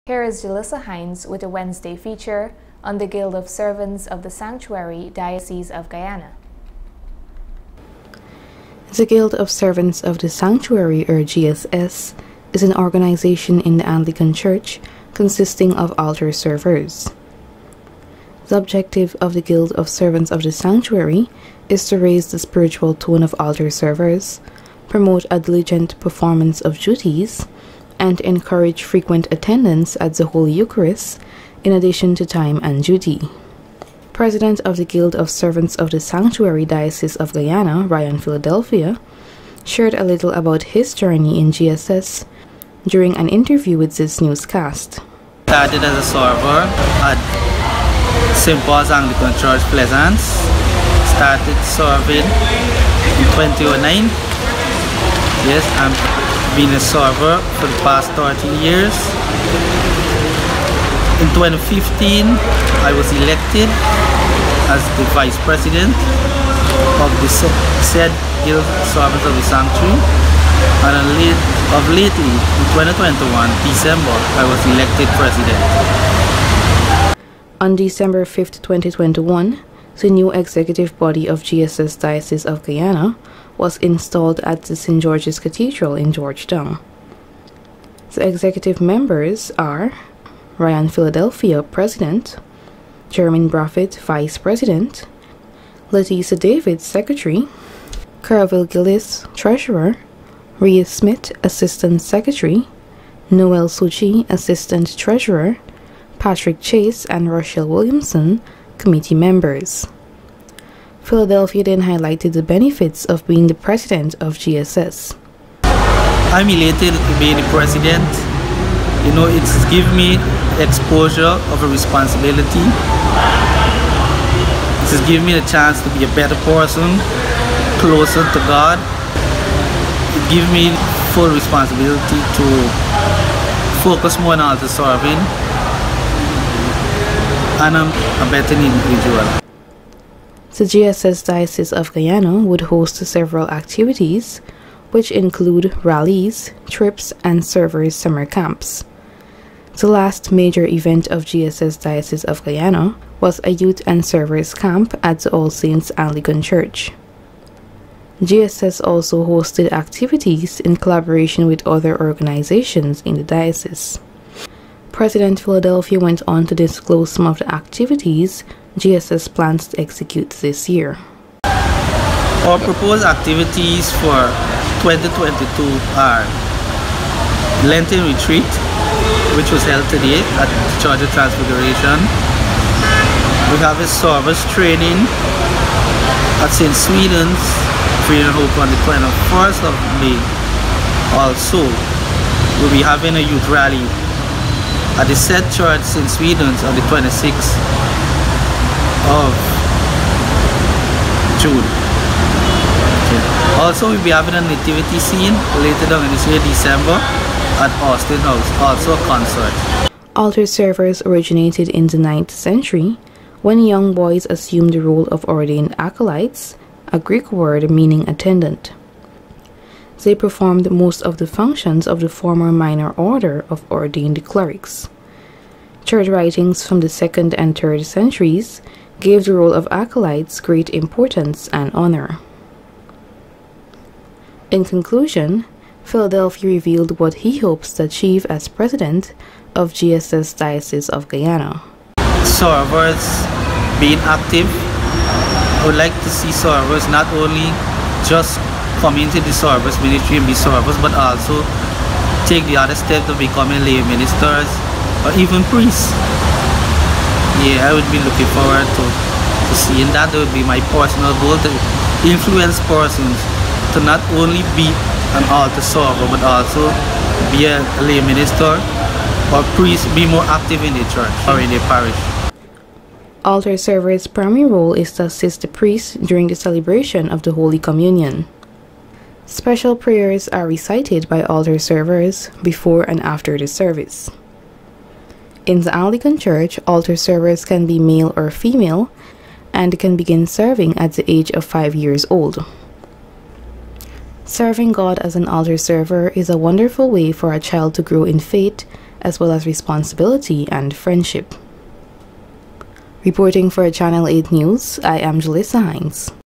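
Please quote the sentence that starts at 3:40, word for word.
They performed most of the functions of the former minor order of ordained clerics.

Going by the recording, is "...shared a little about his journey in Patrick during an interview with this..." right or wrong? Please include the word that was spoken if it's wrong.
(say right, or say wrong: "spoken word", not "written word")
wrong: "GSS", not "Patrick".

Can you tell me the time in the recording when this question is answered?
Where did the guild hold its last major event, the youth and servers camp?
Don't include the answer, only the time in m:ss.
2:35.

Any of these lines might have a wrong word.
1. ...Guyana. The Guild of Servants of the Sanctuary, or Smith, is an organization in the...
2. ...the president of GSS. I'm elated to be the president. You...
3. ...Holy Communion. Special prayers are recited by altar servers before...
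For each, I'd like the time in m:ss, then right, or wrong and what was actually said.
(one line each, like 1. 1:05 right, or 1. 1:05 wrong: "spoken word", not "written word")
1. 0:05 wrong: "GSS", not "Smith"
2. 1:53 right
3. 4:37 right.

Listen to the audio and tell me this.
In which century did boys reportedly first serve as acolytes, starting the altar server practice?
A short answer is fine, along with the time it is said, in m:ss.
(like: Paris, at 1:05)
9th century, at 3:31.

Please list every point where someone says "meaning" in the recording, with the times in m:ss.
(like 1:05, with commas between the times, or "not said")
3:37.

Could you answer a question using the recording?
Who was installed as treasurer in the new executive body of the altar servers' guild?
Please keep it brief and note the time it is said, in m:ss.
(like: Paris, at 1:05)
Carville Gillis, at 1:38.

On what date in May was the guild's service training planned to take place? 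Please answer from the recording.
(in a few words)
21st of May.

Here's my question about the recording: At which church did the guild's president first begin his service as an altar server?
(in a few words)
St. Paul's Anglican Church, Pleasance.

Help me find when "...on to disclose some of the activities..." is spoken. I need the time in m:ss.
2:46.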